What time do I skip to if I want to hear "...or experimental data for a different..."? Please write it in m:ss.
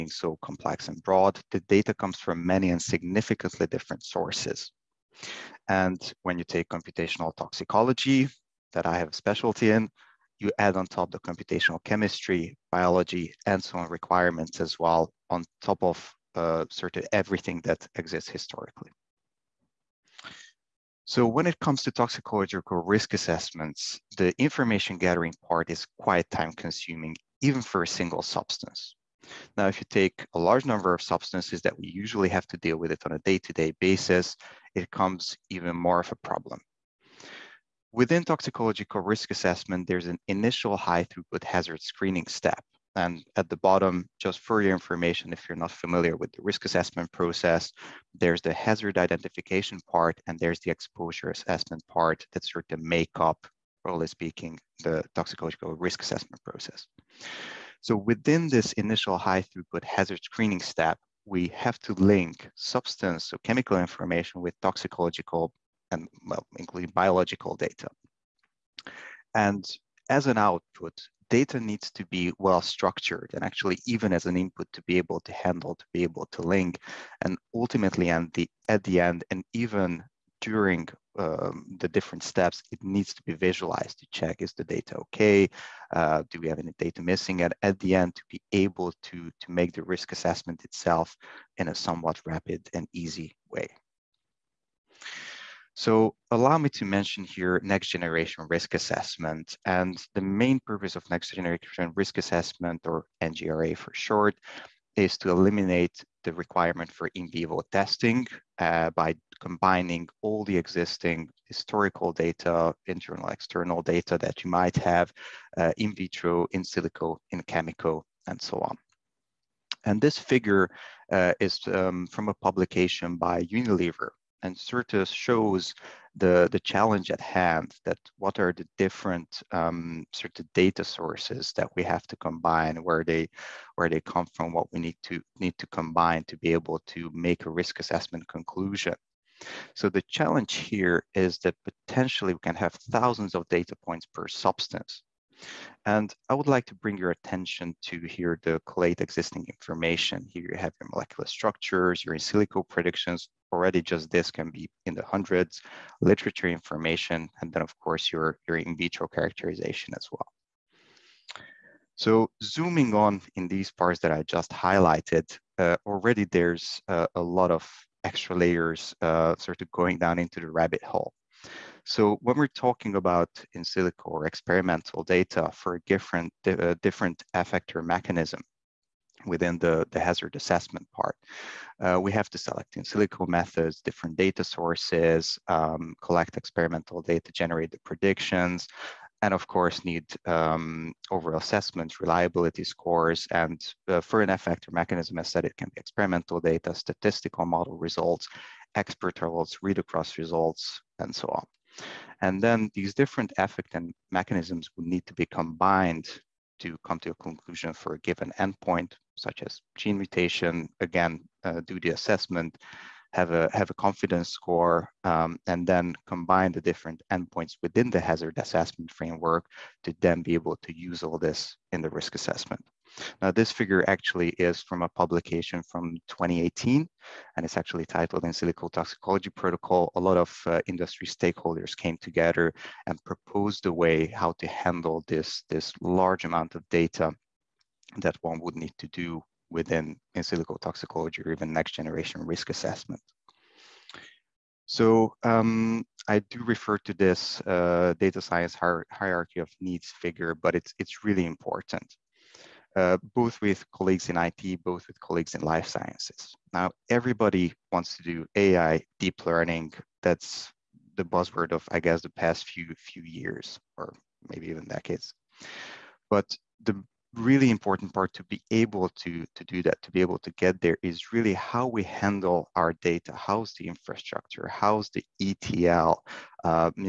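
2:54.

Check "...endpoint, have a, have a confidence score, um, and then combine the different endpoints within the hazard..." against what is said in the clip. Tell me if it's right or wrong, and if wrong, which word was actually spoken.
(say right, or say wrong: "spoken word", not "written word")
wrong: "assessment", not "endpoint".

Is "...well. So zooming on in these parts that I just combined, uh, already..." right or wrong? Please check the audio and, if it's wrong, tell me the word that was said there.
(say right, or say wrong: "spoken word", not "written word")
wrong: "highlighted", not "combined".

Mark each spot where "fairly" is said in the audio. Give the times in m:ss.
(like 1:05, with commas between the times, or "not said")
not said.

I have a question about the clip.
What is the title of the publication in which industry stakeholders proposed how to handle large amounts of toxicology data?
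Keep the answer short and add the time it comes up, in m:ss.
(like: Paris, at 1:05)
In Silico Toxicology Protocol, at 3:48.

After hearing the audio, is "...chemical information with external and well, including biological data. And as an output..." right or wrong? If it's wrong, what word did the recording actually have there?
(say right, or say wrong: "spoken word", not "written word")
wrong: "toxicological", not "external".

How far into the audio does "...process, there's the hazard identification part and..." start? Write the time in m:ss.
0:47.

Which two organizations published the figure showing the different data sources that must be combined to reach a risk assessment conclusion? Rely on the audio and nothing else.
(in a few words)
Unilever and Certus.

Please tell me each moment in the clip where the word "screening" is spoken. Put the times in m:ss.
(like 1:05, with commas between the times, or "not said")
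0:41, 1:00.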